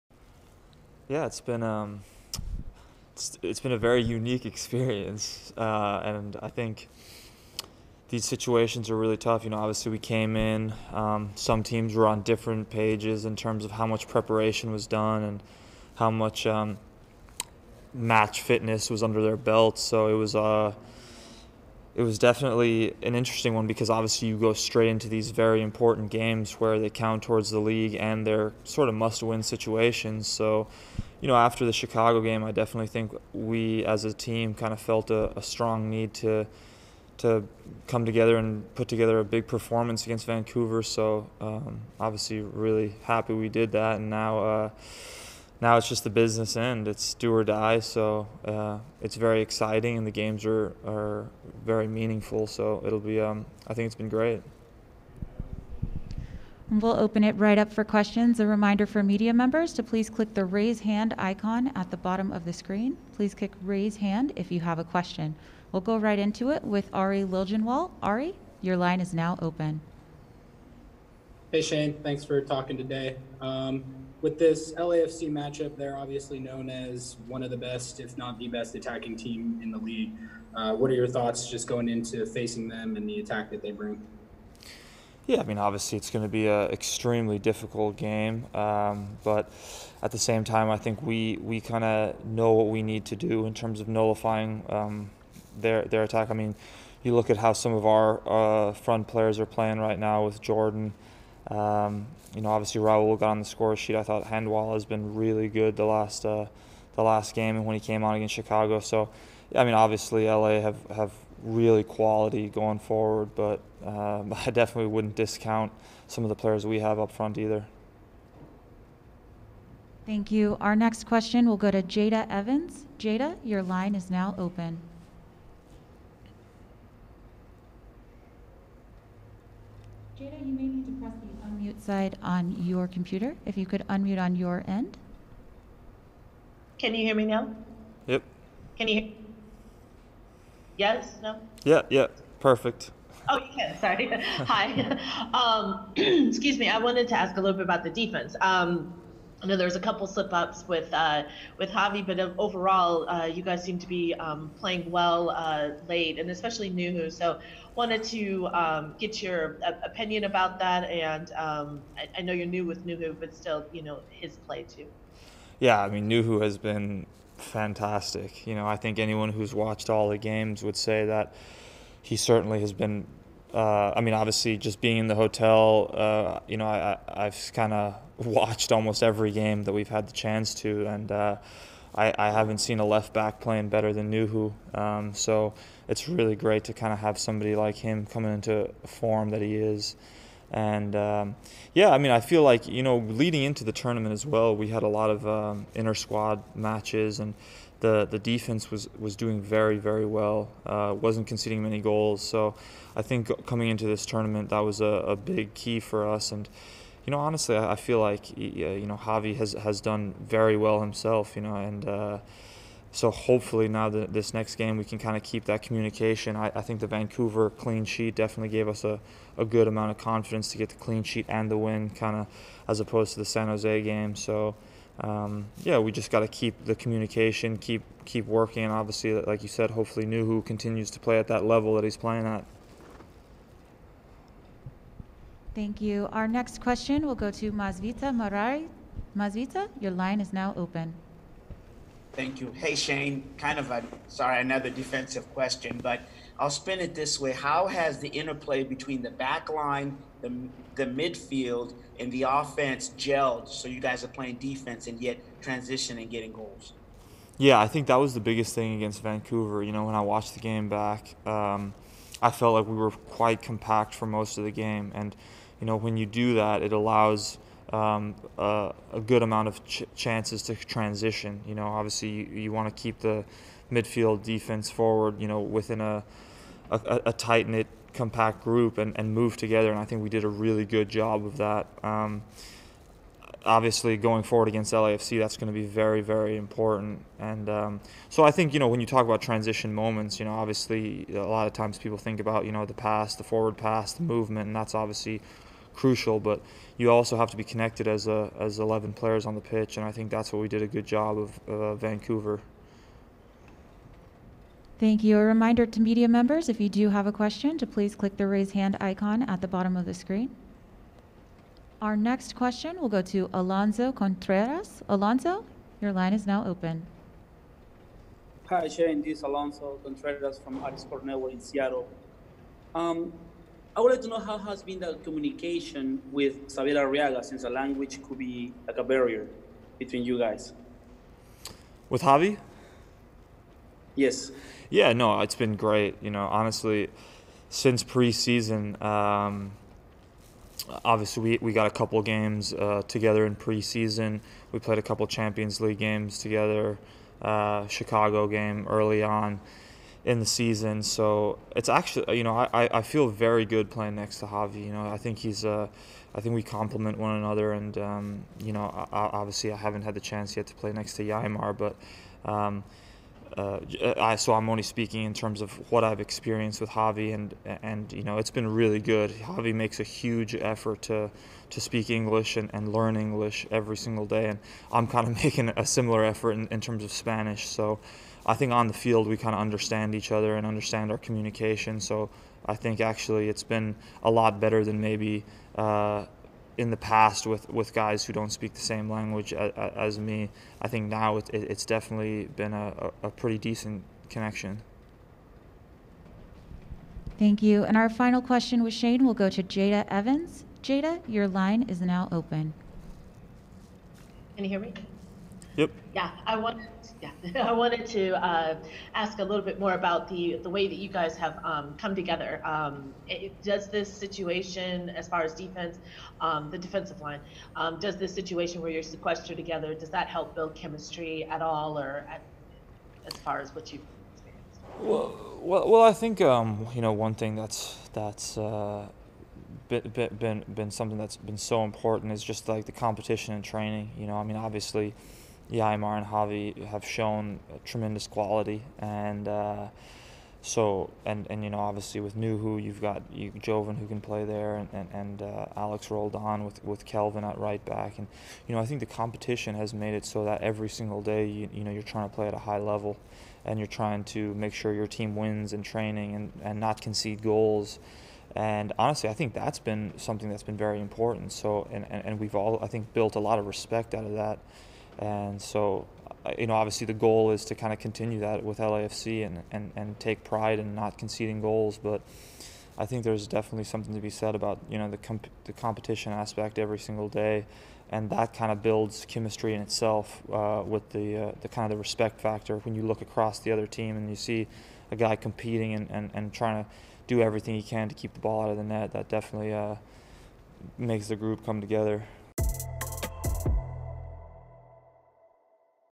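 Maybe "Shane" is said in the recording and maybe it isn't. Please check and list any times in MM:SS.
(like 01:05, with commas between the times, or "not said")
01:11, 04:02, 05:18, 06:38.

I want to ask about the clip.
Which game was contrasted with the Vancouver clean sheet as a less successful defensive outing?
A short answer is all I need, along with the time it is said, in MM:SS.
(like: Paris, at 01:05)
San Jose, at 03:43.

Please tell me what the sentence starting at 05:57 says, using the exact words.
And, um, you know, I, obviously I haven't had the chance yet to play next to Yeimar, but.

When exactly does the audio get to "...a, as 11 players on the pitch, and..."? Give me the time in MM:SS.
04:58.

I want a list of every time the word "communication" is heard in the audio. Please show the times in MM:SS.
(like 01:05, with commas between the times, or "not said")
03:35, 03:46, 05:25, 06:20.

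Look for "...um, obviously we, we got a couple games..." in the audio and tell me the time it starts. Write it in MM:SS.
05:38.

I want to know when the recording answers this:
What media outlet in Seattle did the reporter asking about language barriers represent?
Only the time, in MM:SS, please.
05:20.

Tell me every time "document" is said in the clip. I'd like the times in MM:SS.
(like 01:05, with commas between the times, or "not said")
not said.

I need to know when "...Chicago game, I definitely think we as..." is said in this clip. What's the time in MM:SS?
00:31.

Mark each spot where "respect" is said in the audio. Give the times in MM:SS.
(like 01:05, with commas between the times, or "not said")
07:43, 08:01.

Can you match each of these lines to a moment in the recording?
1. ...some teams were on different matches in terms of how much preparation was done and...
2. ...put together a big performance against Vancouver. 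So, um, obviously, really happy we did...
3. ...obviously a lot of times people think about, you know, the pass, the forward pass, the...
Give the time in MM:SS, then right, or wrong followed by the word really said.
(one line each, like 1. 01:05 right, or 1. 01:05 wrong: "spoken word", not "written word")
1. 00:11 wrong: "pages", not "matches"
2. 00:38 right
3. 04:50 right.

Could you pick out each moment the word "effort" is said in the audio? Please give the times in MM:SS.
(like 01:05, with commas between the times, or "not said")
06:10, 06:16.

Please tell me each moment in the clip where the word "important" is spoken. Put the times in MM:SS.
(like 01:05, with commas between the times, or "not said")
00:25, 04:46, 07:11, 07:40.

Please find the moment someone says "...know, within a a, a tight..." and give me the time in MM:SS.
04:35.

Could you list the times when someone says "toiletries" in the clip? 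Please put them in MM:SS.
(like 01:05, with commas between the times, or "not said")
not said.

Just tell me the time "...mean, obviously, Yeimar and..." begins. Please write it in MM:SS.
07:14.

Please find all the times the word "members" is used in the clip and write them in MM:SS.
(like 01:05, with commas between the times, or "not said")
00:59, 05:06.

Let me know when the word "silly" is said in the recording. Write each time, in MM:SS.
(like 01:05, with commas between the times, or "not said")
not said.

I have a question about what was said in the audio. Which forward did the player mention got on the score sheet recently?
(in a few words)
Raul.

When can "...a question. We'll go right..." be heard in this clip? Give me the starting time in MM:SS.
01:04.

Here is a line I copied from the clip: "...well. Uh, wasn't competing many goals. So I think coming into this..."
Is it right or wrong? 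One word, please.
wrong.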